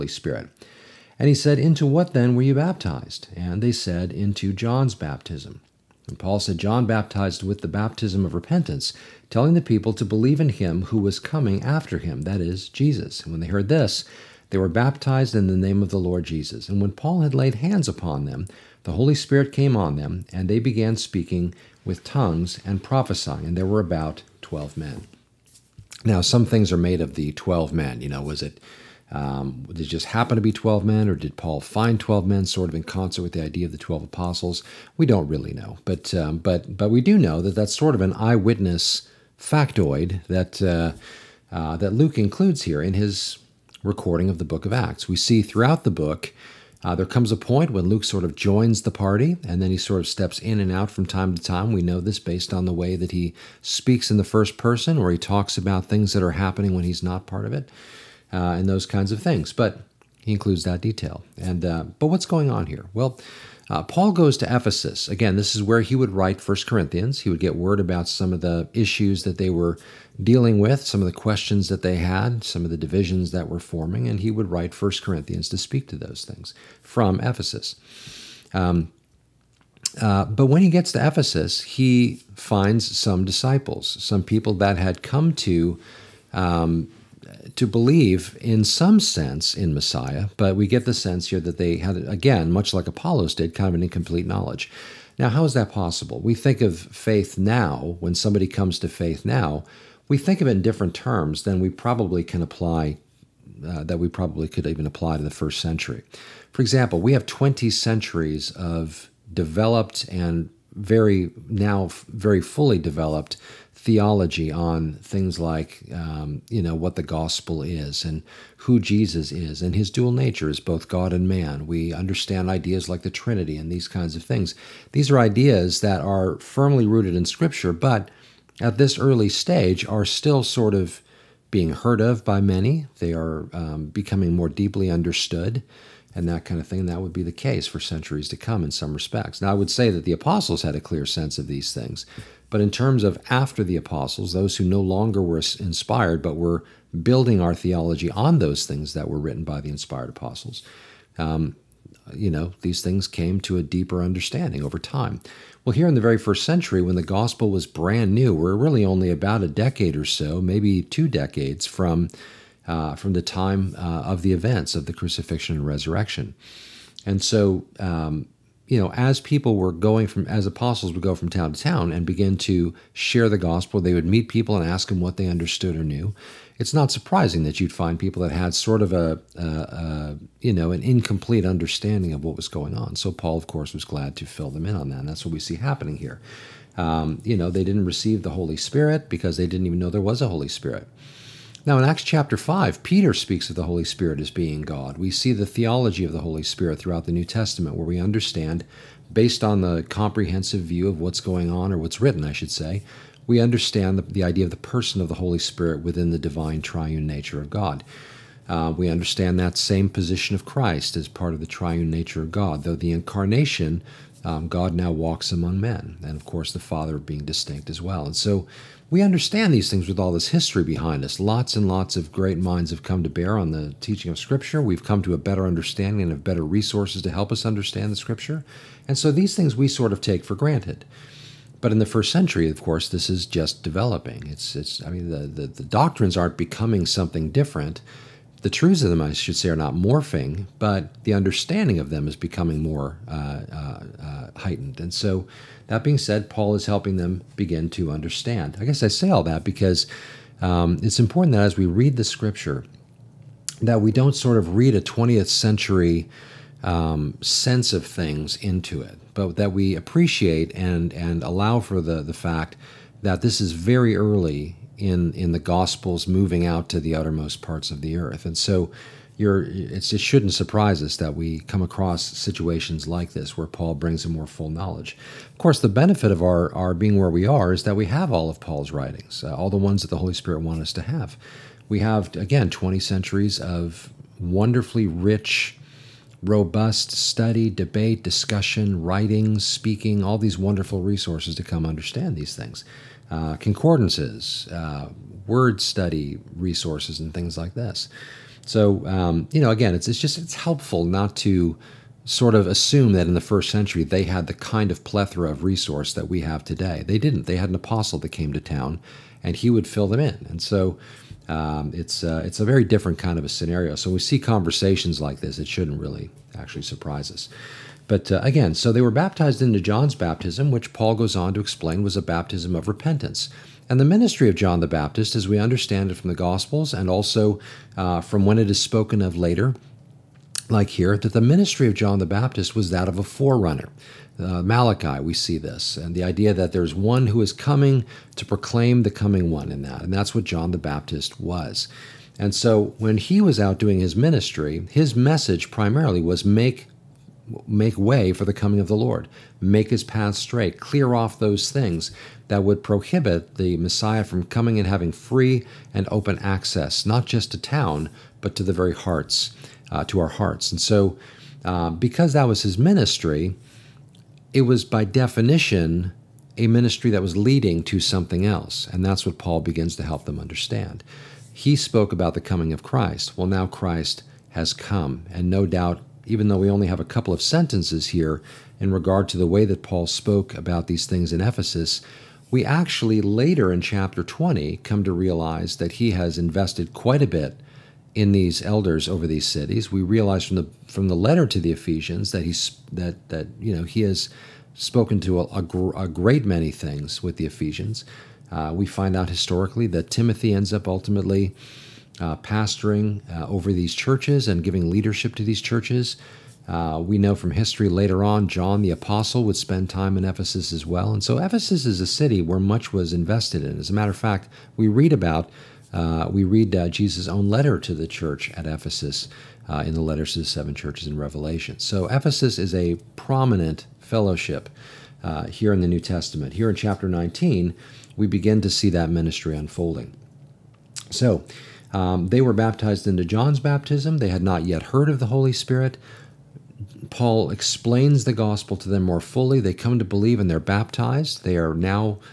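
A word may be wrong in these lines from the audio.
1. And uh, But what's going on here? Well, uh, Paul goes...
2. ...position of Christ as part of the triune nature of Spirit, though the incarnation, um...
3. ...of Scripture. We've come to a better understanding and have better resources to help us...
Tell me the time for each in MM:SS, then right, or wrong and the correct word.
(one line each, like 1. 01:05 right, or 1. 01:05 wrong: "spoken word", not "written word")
1. 01:01 right
2. 03:29 wrong: "God", not "Spirit"
3. 03:44 right.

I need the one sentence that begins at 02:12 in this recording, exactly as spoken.
They are um, becoming more deeply understood and that kind of thing.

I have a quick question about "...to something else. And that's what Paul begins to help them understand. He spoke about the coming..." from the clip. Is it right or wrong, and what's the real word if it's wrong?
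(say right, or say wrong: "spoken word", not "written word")
right.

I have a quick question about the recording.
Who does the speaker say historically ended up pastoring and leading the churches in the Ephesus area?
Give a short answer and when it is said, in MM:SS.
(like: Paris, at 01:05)
Timothy, at 06:39.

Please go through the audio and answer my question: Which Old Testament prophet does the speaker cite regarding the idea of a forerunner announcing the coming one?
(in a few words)
Malachi.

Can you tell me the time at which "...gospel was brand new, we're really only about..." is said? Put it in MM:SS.
02:37.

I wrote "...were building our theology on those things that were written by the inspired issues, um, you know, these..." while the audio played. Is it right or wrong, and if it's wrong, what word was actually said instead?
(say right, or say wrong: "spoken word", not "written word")
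wrong: "apostles", not "issues".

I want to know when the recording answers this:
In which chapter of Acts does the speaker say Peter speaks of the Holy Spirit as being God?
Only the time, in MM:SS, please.
03:11.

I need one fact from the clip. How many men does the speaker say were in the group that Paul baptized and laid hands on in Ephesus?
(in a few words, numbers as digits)
12.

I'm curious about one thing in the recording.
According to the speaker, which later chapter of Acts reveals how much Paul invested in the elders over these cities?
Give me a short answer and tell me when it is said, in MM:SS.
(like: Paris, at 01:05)
Chapter 20, at 06:23.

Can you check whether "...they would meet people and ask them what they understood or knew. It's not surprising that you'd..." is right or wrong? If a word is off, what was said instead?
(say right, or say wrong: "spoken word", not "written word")
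right.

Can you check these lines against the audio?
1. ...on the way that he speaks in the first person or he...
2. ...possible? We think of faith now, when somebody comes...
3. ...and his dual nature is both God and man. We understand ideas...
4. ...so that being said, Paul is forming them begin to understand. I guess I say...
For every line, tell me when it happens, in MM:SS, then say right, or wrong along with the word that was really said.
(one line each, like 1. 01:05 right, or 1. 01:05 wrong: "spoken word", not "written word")
1. 00:52 right
2. 01:35 right
3. 01:59 right
4. 04:04 wrong: "helping", not "forming".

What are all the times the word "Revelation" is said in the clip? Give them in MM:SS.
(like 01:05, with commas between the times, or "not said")
07:00.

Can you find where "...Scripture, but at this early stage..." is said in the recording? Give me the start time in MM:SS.
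02:07.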